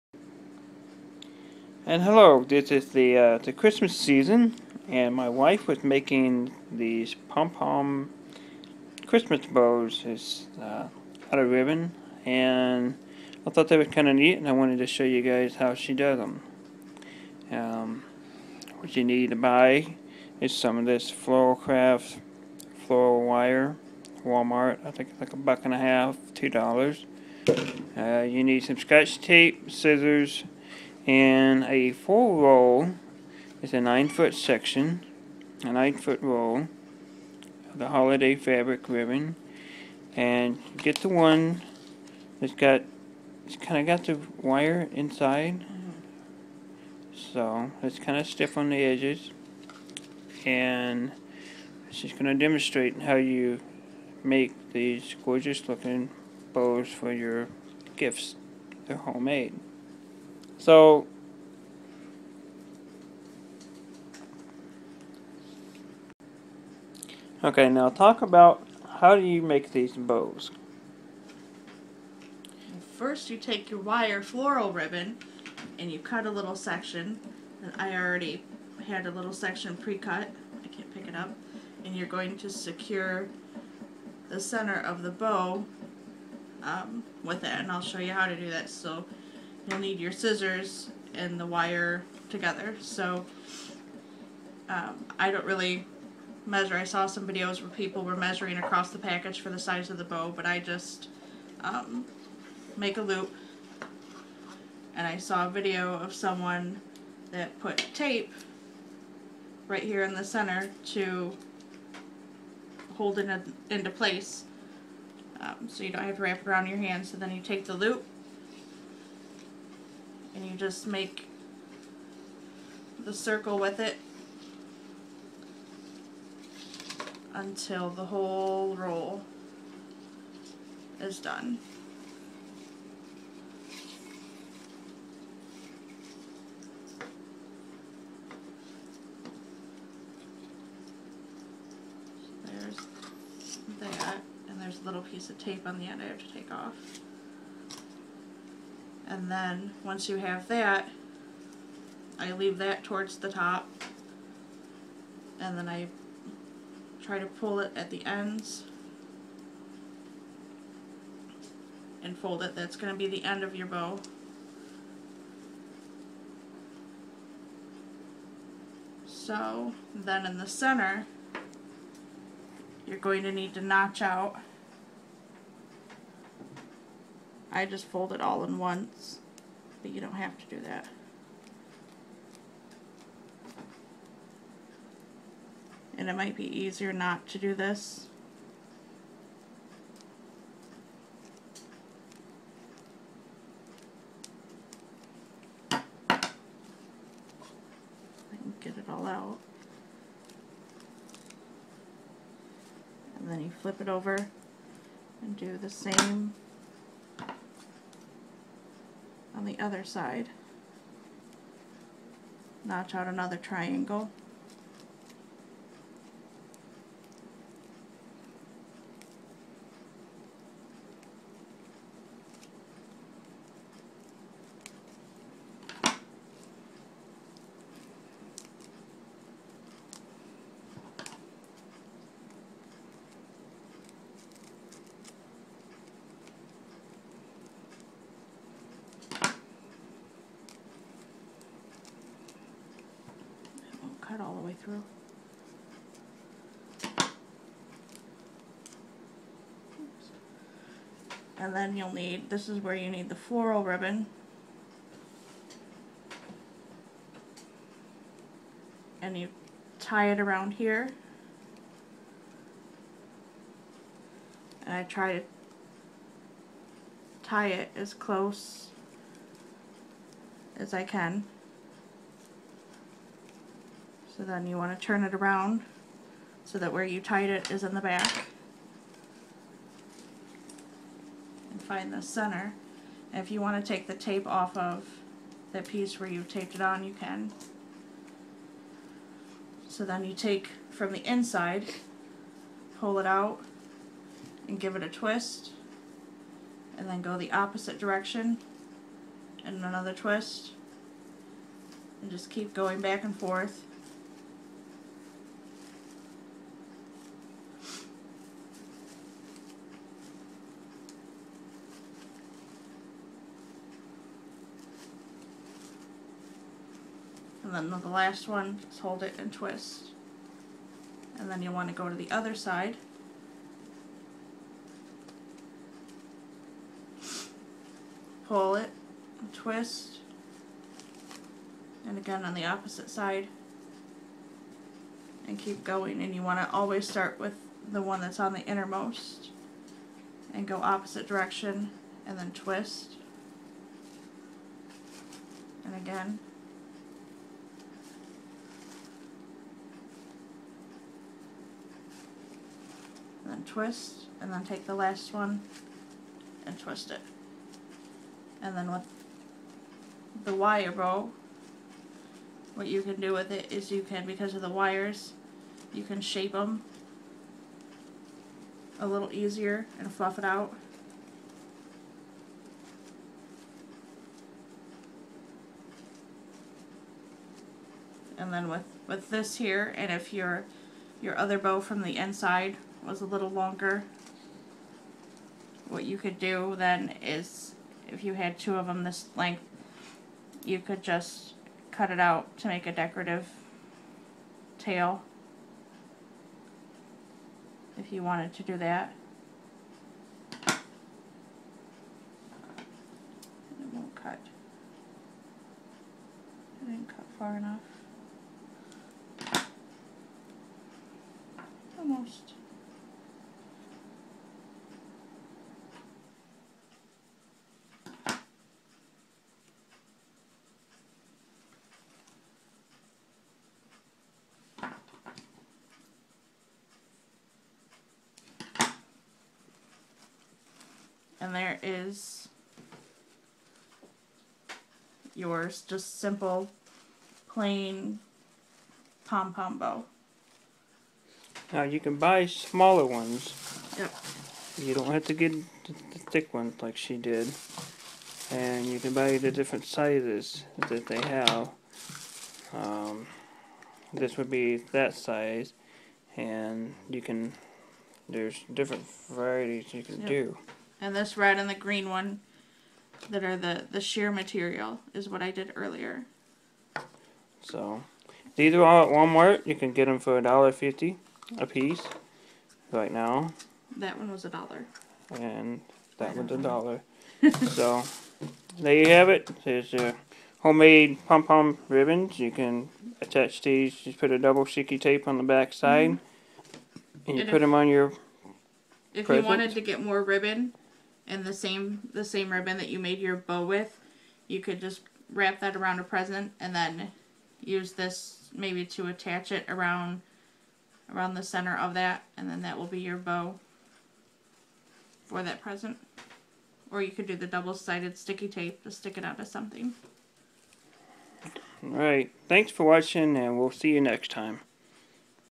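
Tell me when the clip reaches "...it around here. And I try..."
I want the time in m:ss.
4:20.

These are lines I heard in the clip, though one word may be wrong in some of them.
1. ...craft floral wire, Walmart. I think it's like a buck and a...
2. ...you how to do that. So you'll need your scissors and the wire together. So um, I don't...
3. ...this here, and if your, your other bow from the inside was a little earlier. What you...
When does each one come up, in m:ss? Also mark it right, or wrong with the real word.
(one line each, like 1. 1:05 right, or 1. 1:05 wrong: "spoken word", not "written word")
1. 0:21 right
2. 1:27 right
3. 6:19 wrong: "longer", not "earlier".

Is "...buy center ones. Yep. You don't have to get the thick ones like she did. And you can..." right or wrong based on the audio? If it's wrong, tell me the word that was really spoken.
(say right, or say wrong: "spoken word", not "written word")
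wrong: "smaller", not "center".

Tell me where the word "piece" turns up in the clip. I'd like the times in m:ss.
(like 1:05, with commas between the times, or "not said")
2:25, 4:45, 7:51.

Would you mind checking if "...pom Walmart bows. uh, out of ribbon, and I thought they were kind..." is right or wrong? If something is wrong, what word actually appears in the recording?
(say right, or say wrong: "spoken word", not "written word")
wrong: "Christmas", not "Walmart".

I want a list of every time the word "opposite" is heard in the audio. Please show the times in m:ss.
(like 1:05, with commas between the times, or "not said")
4:57, 5:32, 5:40.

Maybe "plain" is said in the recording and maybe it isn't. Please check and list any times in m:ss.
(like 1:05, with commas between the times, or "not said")
7:17.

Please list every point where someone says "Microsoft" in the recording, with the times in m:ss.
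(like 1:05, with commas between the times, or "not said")
not said.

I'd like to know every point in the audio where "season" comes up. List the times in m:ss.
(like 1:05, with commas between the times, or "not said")
0:03.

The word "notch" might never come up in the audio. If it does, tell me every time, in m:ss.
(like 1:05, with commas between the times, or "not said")
2:53, 3:32.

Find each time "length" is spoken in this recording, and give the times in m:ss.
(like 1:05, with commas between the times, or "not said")
6:29.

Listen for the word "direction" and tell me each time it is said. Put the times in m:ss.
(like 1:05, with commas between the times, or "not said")
4:57, 5:41.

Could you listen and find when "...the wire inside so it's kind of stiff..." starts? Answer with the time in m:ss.
0:44.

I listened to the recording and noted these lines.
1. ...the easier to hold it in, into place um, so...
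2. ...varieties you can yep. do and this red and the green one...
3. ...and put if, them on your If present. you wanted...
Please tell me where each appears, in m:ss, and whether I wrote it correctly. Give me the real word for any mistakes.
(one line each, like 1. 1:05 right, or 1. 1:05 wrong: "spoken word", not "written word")
1. 1:50 wrong: "center", not "easier"
2. 7:39 right
3. 8:07 right.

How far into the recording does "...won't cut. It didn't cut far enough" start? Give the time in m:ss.
6:43.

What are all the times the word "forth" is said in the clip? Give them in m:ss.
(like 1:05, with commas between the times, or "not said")
5:03.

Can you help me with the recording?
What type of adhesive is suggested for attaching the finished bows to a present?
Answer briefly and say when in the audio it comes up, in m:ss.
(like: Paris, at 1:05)
double-sided sticky tape, at 8:04.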